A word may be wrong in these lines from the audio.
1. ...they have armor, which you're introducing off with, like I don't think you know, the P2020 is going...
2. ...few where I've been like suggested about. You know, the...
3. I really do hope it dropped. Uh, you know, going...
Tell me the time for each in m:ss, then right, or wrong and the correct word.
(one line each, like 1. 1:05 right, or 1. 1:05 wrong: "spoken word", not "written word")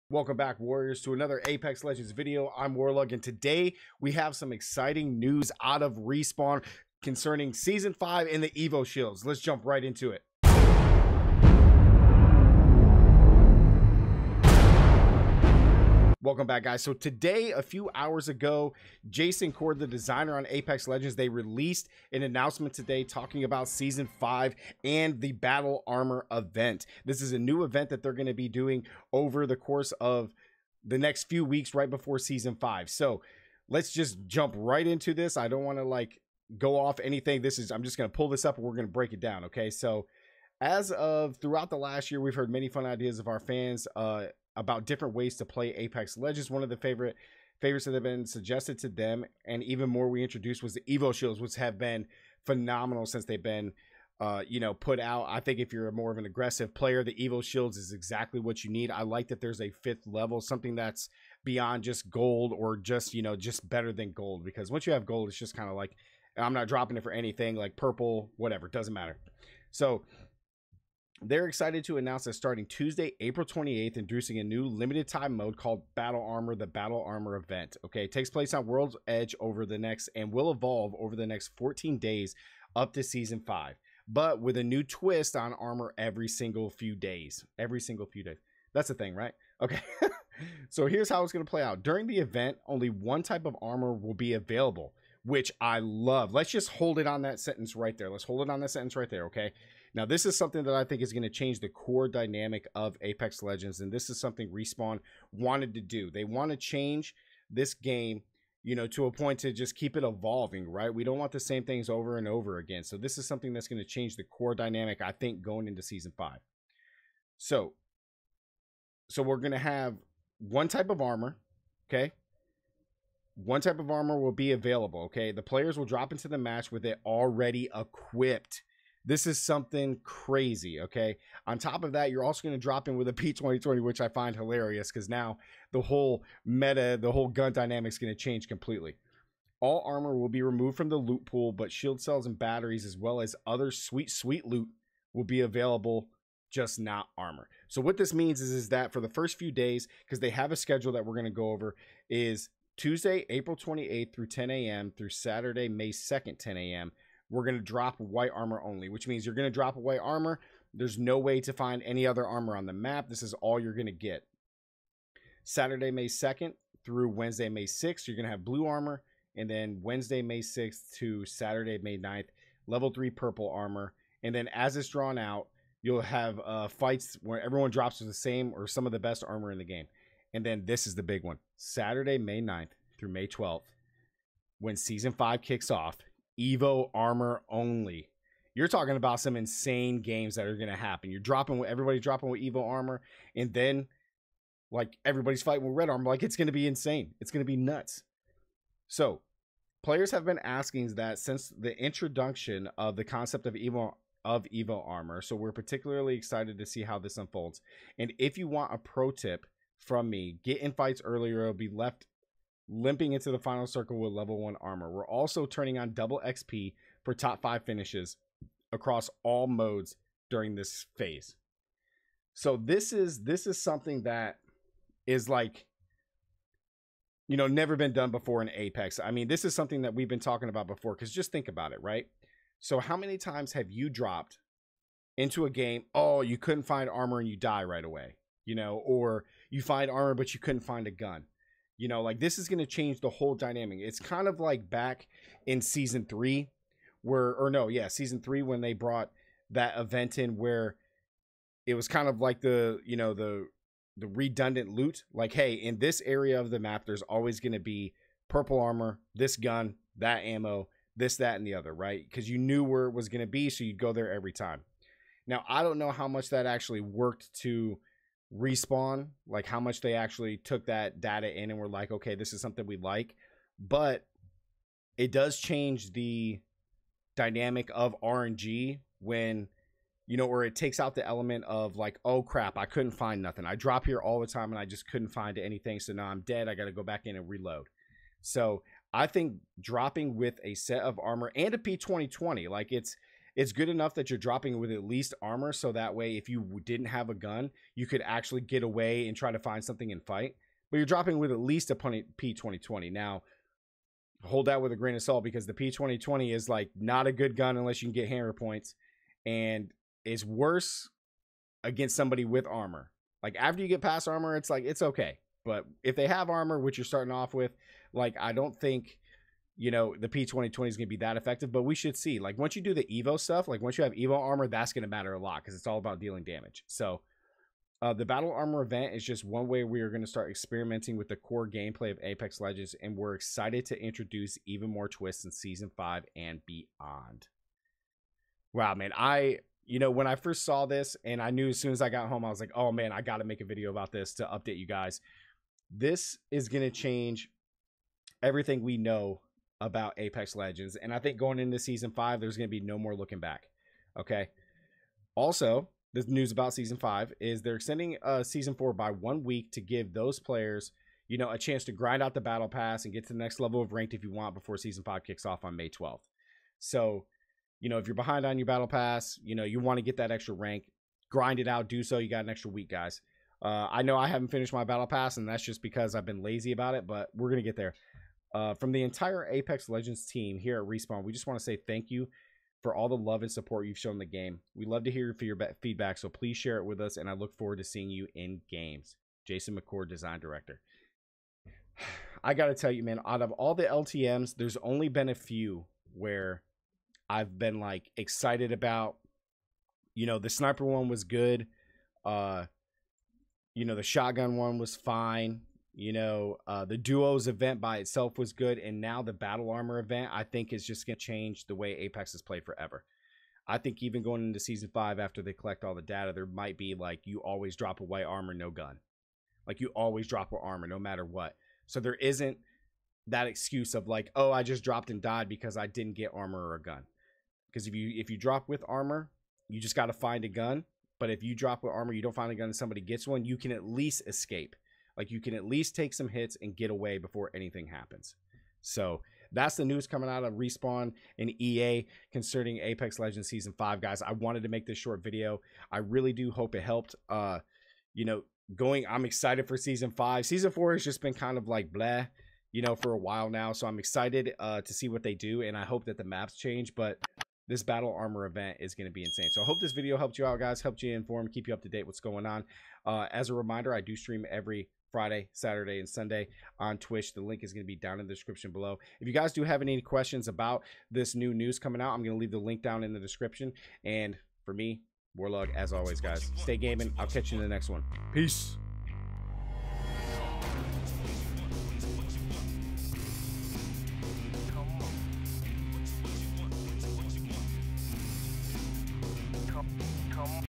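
1. 5:15 wrong: "starting", not "introducing"
2. 6:35 wrong: "excited", not "suggested"
3. 7:25 wrong: "helped", not "dropped".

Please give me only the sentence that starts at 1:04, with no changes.
Because once you have gold, it's just kind of like, I'm not dropping it for anything, like purple, whatever, doesn't matter.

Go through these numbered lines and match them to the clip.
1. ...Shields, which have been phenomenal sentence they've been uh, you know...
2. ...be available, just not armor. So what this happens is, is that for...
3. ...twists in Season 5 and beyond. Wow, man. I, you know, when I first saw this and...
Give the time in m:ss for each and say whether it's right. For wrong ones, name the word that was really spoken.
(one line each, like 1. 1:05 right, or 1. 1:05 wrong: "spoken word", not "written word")
1. 0:51 wrong: "since", not "sentence"
2. 2:25 wrong: "means", not "happens"
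3. 5:34 right.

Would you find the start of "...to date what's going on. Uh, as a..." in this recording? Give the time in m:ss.
7:41.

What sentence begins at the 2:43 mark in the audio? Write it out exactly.
This is all you're going to get.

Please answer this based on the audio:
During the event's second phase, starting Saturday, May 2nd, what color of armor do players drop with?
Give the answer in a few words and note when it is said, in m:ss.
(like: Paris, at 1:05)
Blue, at 2:48.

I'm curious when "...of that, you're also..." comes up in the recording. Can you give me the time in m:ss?
2:11.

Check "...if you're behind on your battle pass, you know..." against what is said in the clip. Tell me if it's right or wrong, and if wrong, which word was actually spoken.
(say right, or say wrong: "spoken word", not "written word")
right.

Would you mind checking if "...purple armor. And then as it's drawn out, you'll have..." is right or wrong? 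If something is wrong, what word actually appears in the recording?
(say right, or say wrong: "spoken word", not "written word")
right.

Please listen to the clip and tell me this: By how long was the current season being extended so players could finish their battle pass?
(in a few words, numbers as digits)
1 week.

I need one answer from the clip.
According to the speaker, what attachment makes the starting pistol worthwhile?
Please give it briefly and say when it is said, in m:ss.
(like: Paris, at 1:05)
Hammer points, at 5:08.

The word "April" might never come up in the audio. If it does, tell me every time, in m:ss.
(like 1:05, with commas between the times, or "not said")
1:13, 2:33.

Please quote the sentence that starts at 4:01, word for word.
You know, like this is going to change the whole dynamic.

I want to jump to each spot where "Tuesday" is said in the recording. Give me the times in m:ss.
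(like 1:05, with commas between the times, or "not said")
1:12, 2:32.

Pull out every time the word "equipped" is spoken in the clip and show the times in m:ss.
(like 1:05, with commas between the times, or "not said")
2:07.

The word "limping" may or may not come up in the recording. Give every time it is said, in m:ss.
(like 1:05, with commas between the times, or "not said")
3:32.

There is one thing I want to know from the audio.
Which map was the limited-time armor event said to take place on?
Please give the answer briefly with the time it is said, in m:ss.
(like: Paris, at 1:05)
World's Edge, at 1:18.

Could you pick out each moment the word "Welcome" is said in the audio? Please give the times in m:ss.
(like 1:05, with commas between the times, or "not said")
0:00, 0:16.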